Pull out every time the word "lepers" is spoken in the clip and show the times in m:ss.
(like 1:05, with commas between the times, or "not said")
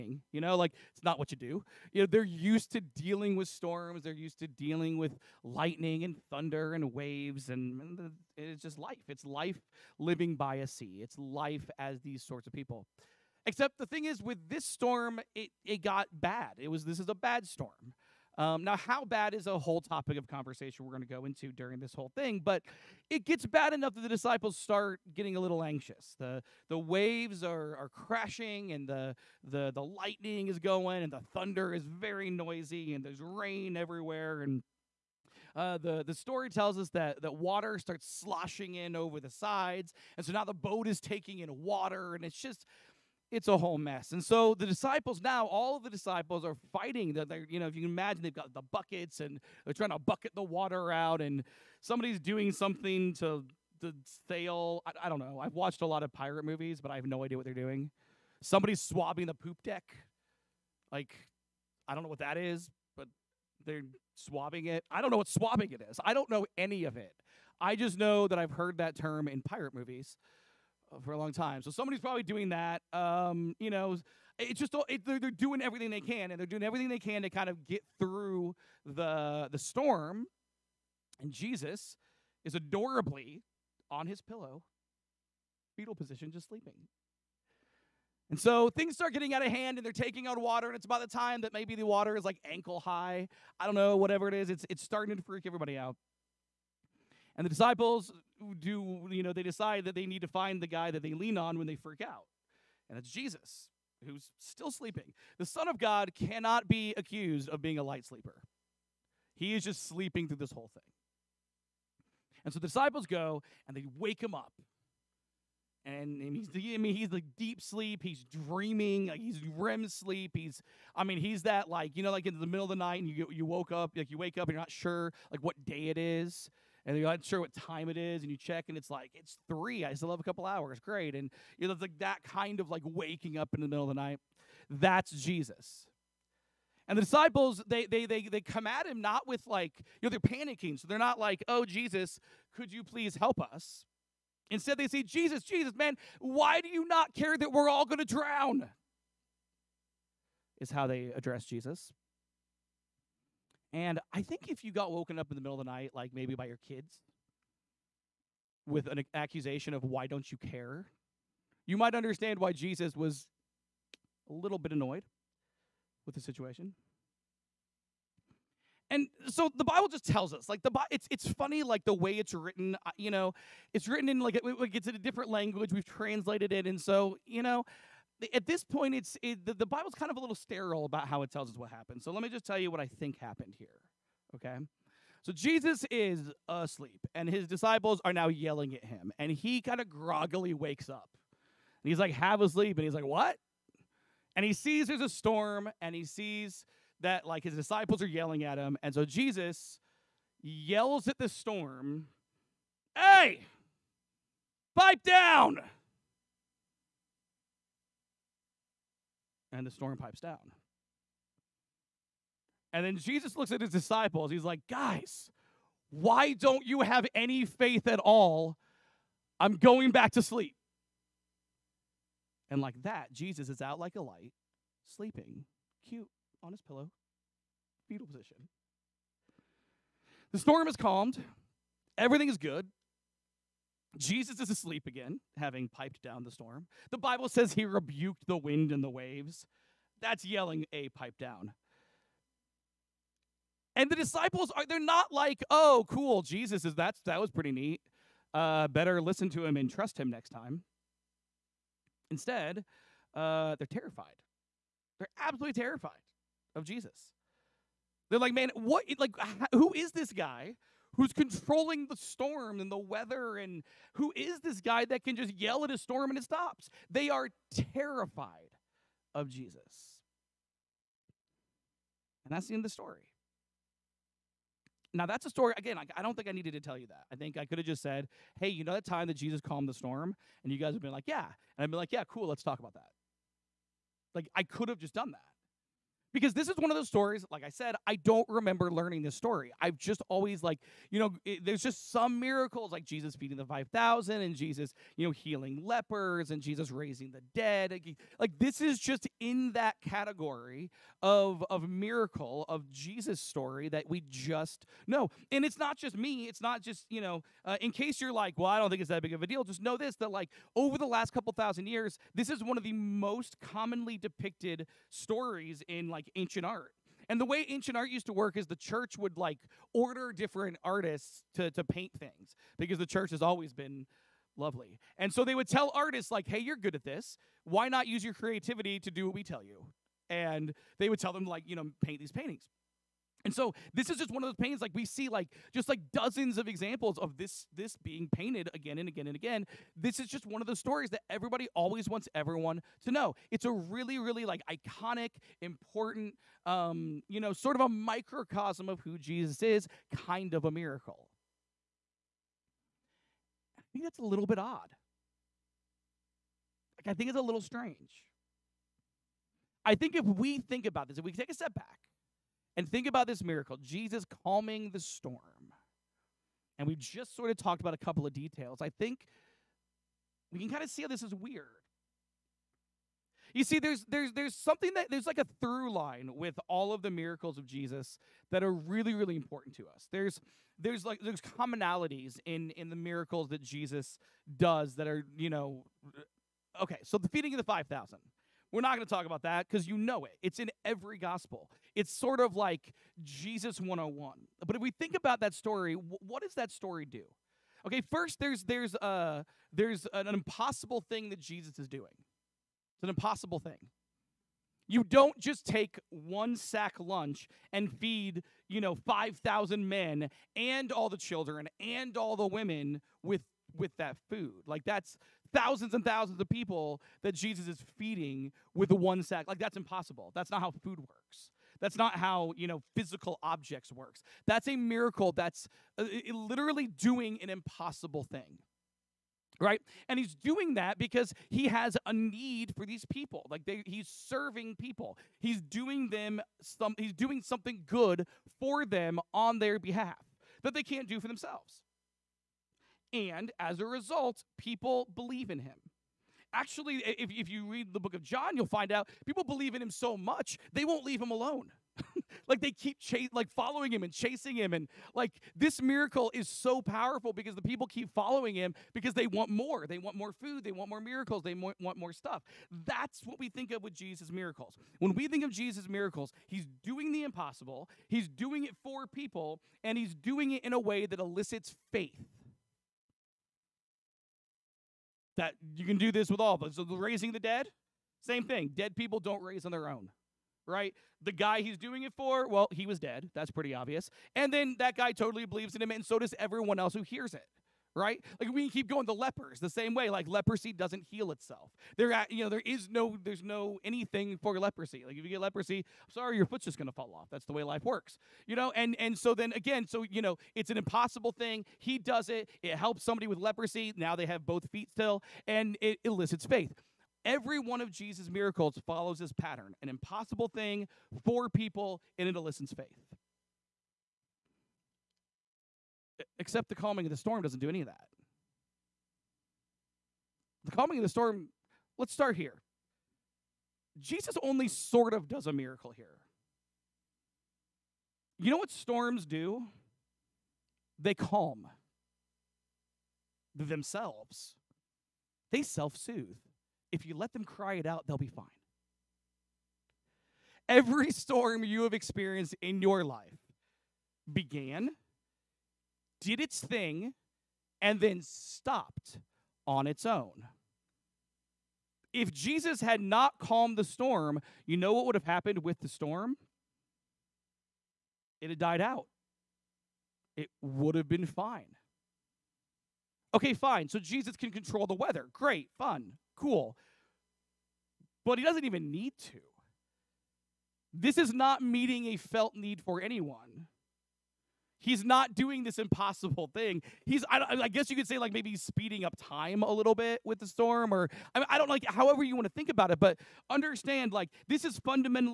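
4:55, 8:08.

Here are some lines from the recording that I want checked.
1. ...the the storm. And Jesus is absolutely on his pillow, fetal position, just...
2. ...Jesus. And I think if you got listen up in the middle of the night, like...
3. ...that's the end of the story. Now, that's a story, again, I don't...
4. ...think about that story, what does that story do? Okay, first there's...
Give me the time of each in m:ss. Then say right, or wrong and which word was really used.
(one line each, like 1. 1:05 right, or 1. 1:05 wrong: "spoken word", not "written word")
1. 1:18 wrong: "adorably", not "absolutely"
2. 2:31 wrong: "woken", not "listen"
3. 4:32 right
4. 6:34 right.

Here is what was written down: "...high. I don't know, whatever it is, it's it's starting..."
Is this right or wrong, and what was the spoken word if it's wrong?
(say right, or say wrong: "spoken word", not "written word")
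right.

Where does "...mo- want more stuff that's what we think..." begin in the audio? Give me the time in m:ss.
7:41.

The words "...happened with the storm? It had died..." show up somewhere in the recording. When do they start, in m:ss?
9:15.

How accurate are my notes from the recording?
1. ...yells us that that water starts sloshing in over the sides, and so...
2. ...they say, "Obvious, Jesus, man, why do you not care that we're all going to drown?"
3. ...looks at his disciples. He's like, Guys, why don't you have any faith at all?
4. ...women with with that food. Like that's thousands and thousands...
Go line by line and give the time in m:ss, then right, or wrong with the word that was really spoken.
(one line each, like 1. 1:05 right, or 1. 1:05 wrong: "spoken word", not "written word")
1. 0:36 wrong: "tells", not "yells"
2. 2:24 wrong: "Jesus", not "Obvious"
3. 3:33 right
4. 6:52 right.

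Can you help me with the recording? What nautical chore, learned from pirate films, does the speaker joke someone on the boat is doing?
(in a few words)
Swabbing the poop deck.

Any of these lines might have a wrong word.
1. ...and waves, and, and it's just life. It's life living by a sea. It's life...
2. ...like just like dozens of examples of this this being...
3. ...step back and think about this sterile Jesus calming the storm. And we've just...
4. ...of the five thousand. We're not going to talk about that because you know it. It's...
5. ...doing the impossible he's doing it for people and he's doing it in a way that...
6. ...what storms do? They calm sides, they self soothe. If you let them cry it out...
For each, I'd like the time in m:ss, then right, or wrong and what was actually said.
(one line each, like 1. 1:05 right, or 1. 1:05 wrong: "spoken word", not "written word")
1. 0:06 right
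2. 5:35 right
3. 6:01 wrong: "miracle", not "sterile"
4. 6:27 right
5. 7:46 right
6. 8:48 wrong: "themselves", not "sides".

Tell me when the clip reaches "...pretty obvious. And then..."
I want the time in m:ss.
8:03.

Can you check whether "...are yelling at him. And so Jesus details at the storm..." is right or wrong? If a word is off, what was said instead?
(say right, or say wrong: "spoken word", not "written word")
wrong: "yells", not "details".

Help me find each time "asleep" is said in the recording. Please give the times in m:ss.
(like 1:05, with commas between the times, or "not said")
3:06, 3:54.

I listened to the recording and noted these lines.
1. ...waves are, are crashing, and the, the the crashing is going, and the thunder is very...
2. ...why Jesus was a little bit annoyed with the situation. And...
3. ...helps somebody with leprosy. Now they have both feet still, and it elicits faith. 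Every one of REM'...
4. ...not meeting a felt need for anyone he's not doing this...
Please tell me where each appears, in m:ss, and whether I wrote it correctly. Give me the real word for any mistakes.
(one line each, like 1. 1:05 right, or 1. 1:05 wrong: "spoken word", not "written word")
1. 0:26 wrong: "lightning", not "crashing"
2. 2:42 right
3. 8:22 wrong: "Jesus", not "REM"
4. 9:31 right.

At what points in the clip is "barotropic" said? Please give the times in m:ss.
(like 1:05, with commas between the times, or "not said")
not said.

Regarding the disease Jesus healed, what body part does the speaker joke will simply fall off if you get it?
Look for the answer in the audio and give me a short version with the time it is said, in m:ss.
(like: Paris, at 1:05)
Your foot, at 8:16.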